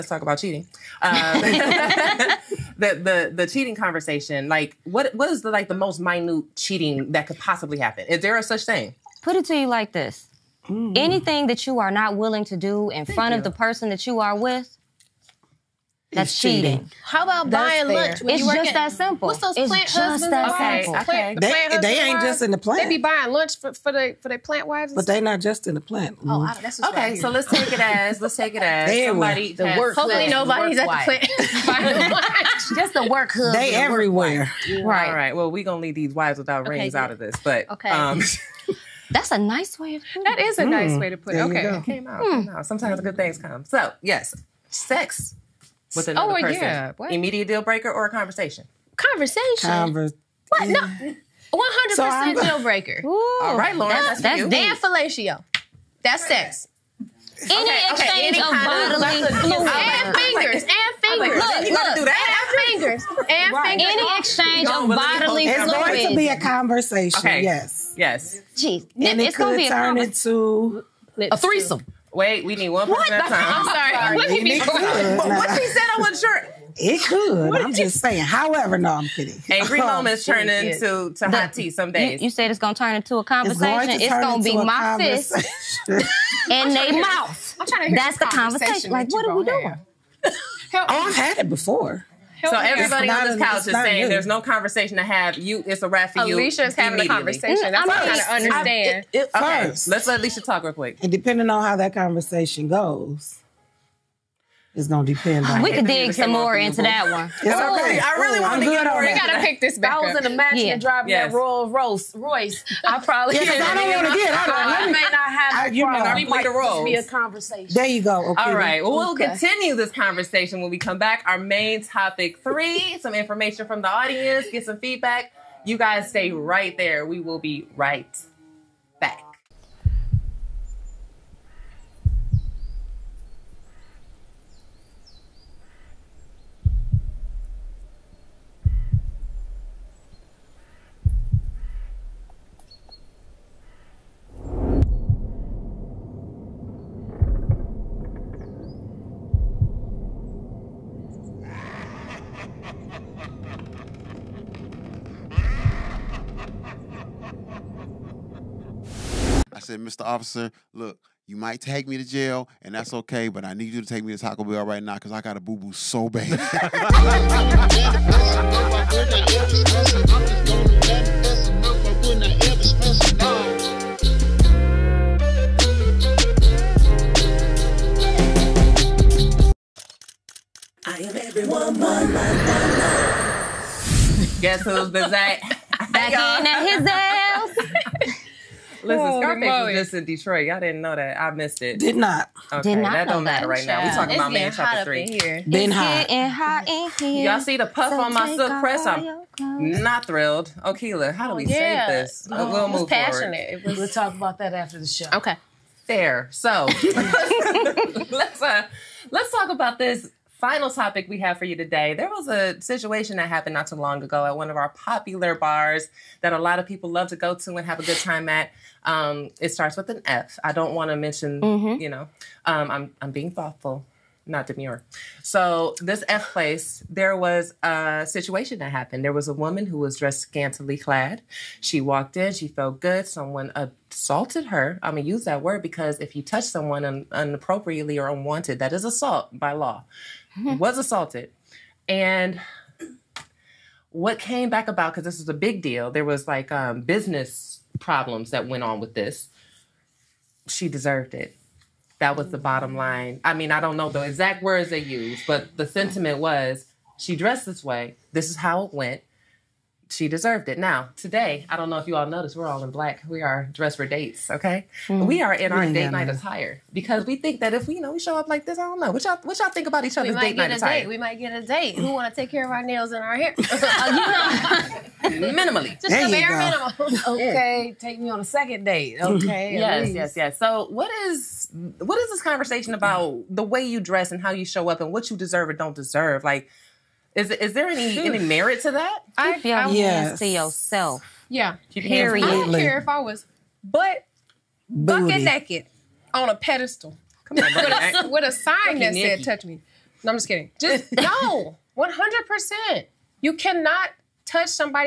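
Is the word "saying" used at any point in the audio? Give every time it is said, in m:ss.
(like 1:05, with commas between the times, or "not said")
1:17, 1:33.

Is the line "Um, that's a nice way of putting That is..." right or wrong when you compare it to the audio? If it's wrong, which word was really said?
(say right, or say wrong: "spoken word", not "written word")
right.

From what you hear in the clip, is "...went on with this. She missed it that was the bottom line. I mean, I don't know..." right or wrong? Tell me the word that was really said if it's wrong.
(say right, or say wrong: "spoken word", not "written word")
wrong: "deserved", not "missed".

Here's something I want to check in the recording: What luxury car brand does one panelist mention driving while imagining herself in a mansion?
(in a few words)
Rolls Royce.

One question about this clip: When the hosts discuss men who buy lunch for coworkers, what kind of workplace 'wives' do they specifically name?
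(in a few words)
Plant wives.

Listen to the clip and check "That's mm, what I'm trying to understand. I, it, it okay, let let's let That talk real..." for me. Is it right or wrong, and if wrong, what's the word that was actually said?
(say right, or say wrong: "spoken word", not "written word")
wrong: "Alicia", not "That".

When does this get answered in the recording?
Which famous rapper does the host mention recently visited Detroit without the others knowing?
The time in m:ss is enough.
3:09.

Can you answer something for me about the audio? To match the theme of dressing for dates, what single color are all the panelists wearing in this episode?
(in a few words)
Black.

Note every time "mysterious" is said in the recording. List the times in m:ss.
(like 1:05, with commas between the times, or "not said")
not said.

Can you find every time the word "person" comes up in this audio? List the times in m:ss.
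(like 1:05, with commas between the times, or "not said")
0:13, 0:46.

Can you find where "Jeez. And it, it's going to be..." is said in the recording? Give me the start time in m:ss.
1:08.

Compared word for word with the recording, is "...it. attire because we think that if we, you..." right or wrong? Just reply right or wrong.
right.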